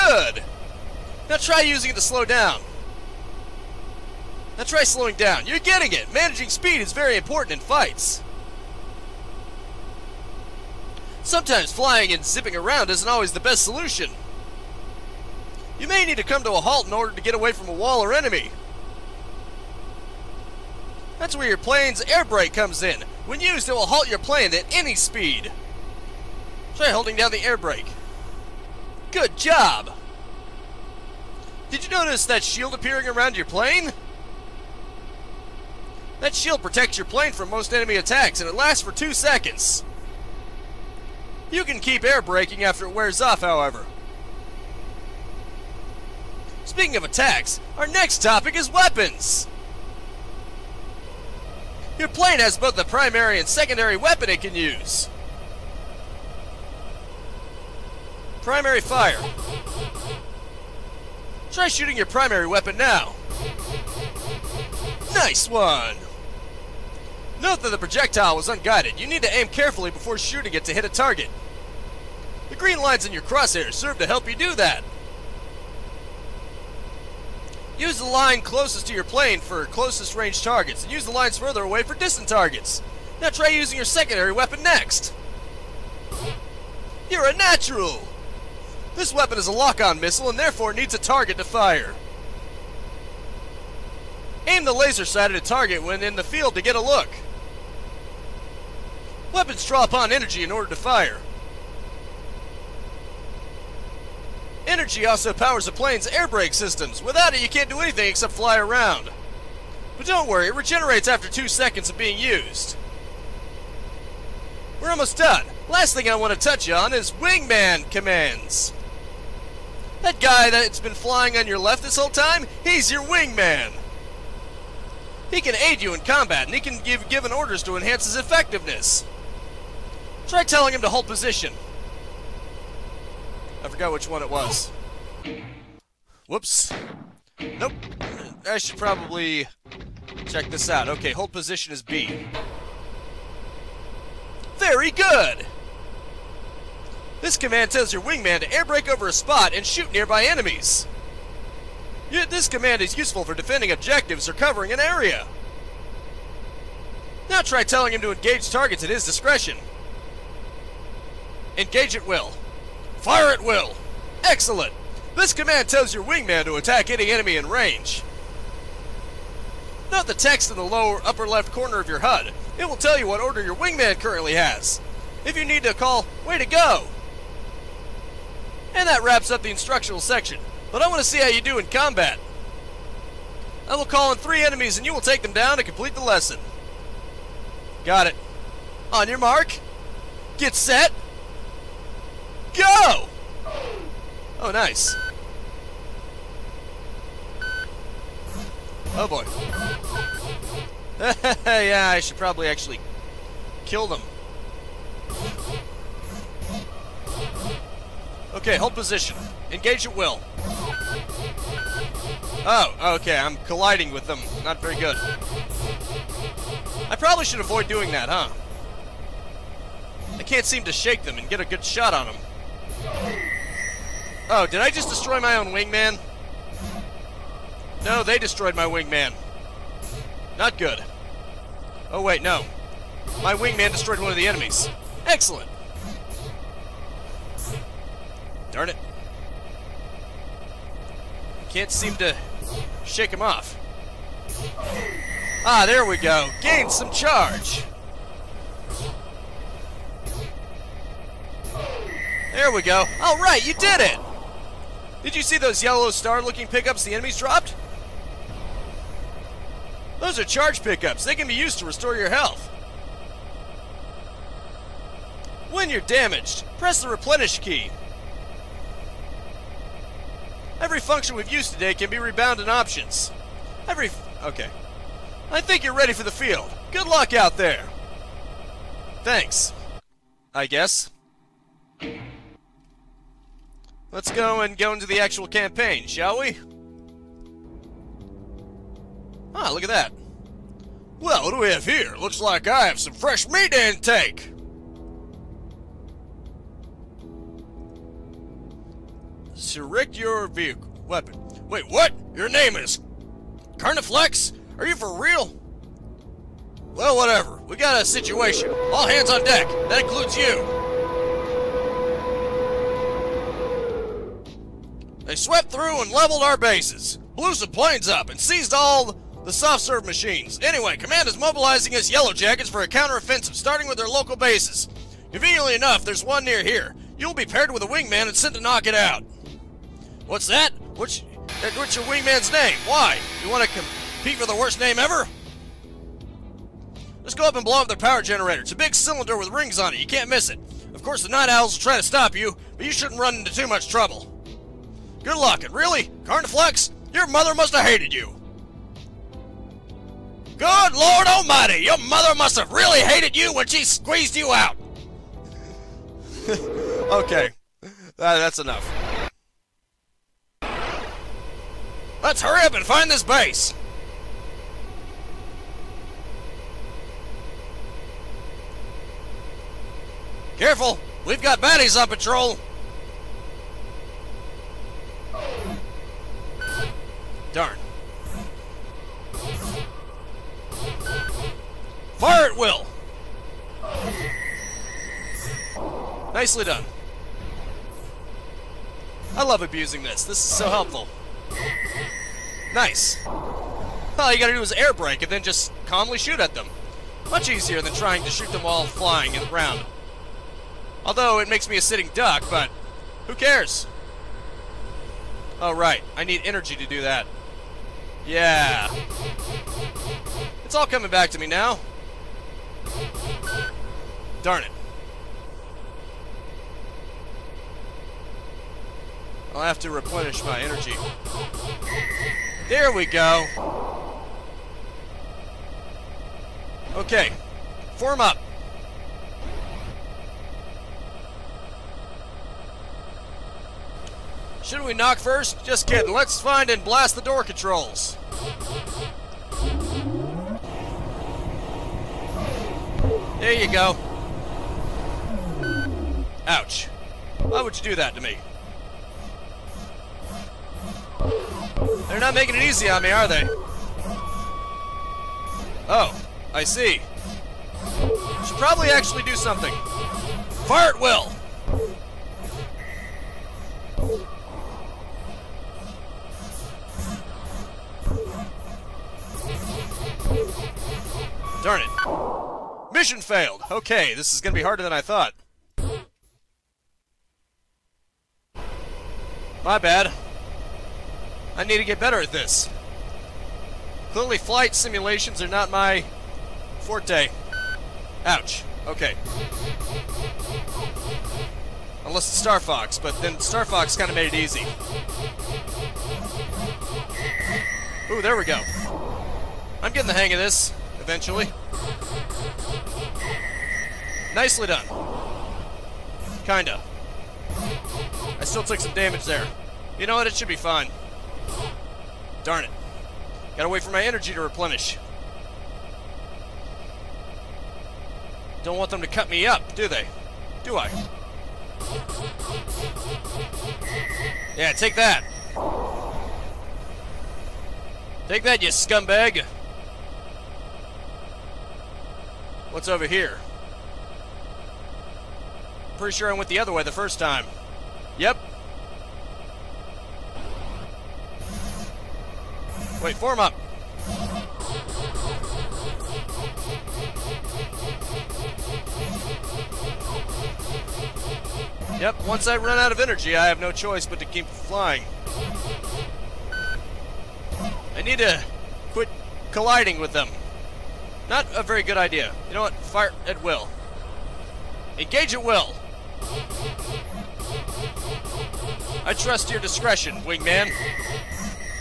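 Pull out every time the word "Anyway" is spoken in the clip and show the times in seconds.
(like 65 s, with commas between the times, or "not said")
320 s.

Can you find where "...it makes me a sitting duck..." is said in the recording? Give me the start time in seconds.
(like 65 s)
401 s.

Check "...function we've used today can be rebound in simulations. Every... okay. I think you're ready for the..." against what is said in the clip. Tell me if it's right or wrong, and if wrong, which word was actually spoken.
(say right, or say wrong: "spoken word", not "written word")
wrong: "options", not "simulations".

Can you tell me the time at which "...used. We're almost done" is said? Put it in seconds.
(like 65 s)
112 s.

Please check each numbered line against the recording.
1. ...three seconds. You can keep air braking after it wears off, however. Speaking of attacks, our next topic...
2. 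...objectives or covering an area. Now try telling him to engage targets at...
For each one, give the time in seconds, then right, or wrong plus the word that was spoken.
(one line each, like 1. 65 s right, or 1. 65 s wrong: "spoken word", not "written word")
1. 38 s wrong: "two", not "three"
2. 153 s right.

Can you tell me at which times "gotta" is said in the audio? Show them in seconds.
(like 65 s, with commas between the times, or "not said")
394 s, 513 s.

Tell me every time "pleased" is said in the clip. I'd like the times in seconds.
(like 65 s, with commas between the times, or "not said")
not said.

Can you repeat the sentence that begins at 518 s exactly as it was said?
Don't want them to cut me up, do they?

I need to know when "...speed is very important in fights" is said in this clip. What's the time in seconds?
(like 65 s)
6 s.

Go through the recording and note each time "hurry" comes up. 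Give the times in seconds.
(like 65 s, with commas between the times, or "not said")
362 s.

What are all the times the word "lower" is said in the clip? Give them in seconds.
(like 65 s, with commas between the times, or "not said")
170 s.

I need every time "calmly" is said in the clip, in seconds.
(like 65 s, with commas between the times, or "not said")
395 s.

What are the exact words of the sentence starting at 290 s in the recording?
Well, what do we have here?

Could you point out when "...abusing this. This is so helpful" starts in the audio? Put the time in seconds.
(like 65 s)
389 s.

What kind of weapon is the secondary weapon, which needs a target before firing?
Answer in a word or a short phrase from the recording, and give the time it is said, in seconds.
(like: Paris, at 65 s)
Lock-on missile, at 89 s.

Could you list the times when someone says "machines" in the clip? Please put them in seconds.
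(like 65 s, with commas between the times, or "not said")
319 s.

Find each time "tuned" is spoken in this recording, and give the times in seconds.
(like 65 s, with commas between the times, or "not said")
not said.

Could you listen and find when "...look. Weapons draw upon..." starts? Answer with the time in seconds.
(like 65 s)
96 s.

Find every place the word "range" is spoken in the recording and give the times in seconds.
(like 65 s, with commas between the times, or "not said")
80 s, 167 s.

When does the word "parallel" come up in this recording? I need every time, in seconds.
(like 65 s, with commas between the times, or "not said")
not said.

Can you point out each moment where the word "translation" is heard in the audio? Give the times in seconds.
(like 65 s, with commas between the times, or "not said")
not said.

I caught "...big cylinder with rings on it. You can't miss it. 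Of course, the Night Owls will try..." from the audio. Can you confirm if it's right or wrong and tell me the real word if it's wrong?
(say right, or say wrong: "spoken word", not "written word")
right.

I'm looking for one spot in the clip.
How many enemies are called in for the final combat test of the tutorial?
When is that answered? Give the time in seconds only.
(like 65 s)
184 s.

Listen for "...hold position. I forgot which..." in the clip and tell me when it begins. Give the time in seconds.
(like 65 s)
130 s.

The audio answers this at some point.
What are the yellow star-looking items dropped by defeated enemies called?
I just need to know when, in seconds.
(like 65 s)
260 s.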